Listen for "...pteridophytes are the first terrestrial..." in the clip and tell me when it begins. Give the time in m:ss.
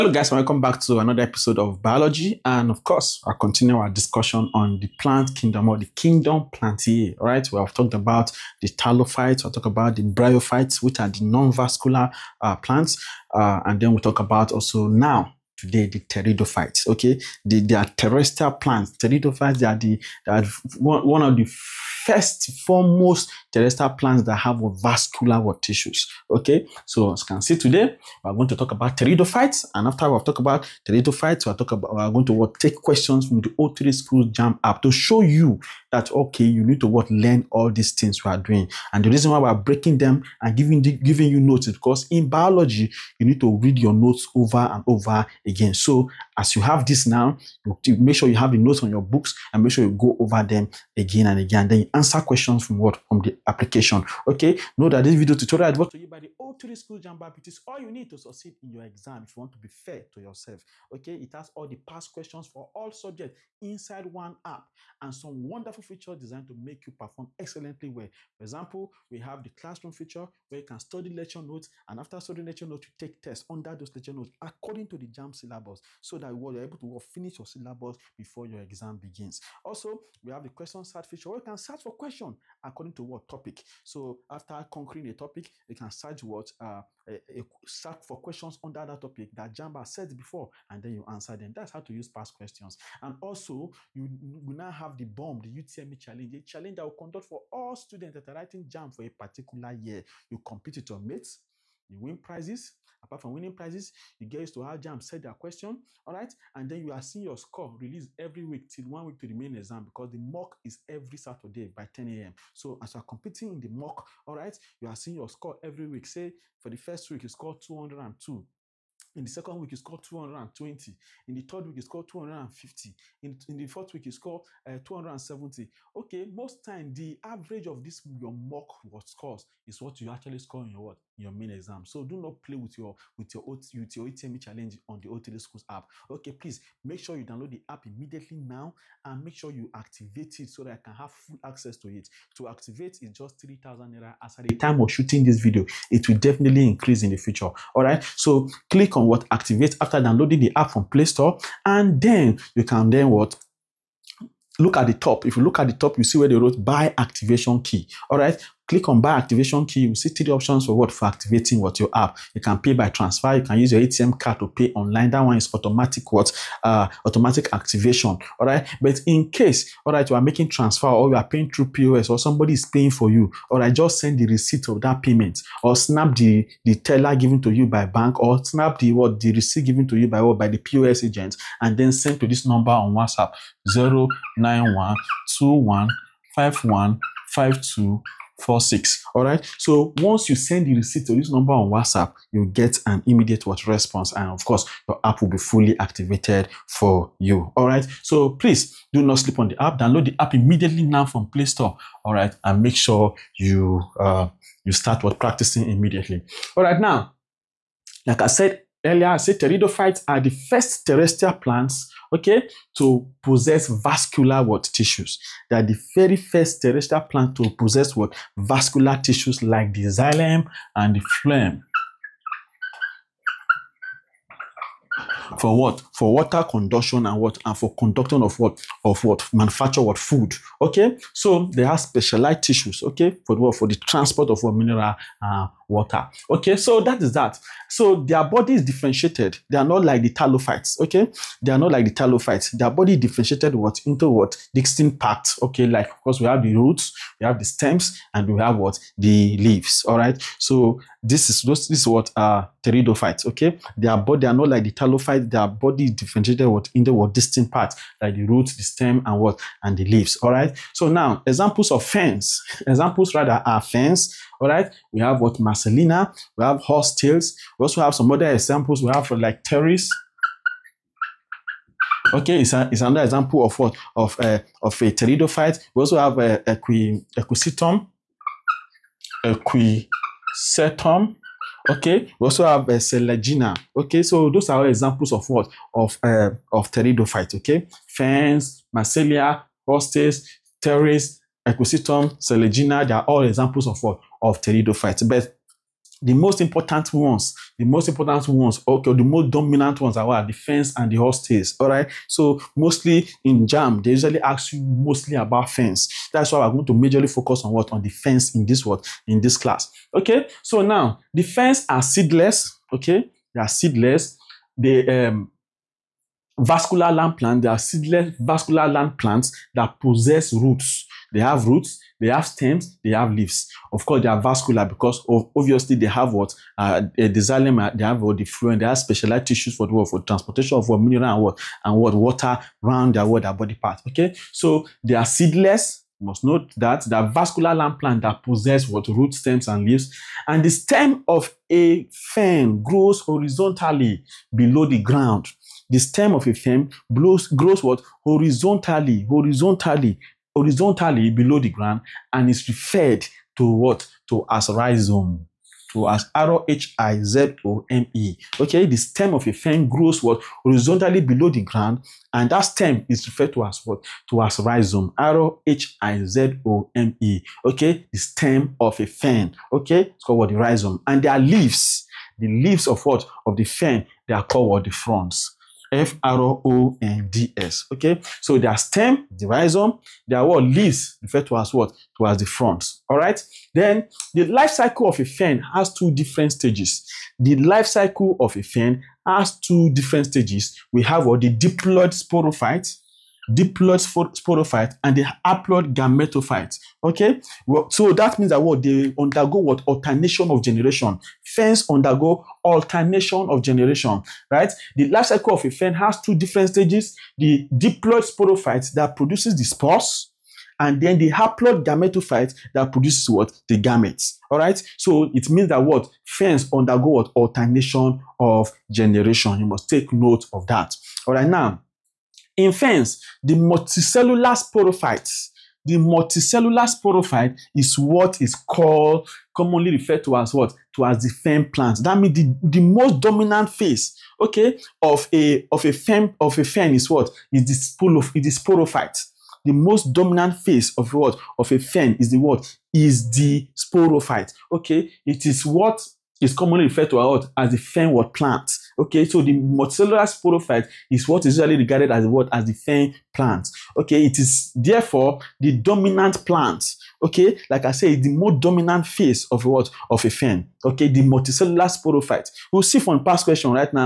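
3:29.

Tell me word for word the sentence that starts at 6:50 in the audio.
And then the haploid gametophyte that produces what?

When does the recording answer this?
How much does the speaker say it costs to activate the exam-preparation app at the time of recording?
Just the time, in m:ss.
2:23.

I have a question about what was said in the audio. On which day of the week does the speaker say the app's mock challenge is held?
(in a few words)
Saturday.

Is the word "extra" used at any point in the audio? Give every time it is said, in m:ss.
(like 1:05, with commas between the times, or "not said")
not said.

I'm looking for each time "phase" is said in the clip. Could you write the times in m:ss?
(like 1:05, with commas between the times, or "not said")
7:13, 7:20, 7:38.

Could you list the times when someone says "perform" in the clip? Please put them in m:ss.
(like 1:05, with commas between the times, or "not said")
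1:06.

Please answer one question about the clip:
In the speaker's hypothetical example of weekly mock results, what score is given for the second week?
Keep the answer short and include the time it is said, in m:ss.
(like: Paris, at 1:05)
220, at 2:00.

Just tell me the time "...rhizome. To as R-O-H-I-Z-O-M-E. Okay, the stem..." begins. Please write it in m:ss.
5:54.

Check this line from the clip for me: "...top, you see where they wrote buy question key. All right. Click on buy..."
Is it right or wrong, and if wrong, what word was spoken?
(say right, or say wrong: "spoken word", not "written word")
wrong: "activation", not "question".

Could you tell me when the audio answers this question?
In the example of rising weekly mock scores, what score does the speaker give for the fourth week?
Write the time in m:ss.
2:04.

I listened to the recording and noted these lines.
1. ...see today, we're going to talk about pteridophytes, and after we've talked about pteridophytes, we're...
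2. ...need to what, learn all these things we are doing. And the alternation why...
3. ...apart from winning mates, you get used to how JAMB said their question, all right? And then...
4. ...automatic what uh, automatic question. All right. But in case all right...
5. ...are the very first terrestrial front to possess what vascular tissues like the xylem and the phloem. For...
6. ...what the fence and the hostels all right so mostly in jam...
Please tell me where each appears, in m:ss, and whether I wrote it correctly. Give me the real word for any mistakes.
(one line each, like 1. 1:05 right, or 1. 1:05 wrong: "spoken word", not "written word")
1. 0:27 right
2. 0:36 wrong: "reason", not "alternation"
3. 1:43 wrong: "prizes", not "mates"
4. 2:45 wrong: "activation", not "question"
5. 3:35 wrong: "plant", not "front"
6. 5:00 right.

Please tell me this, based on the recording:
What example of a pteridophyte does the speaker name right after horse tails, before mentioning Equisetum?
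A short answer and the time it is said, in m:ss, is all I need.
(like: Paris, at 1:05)
Pteris, at 4:29.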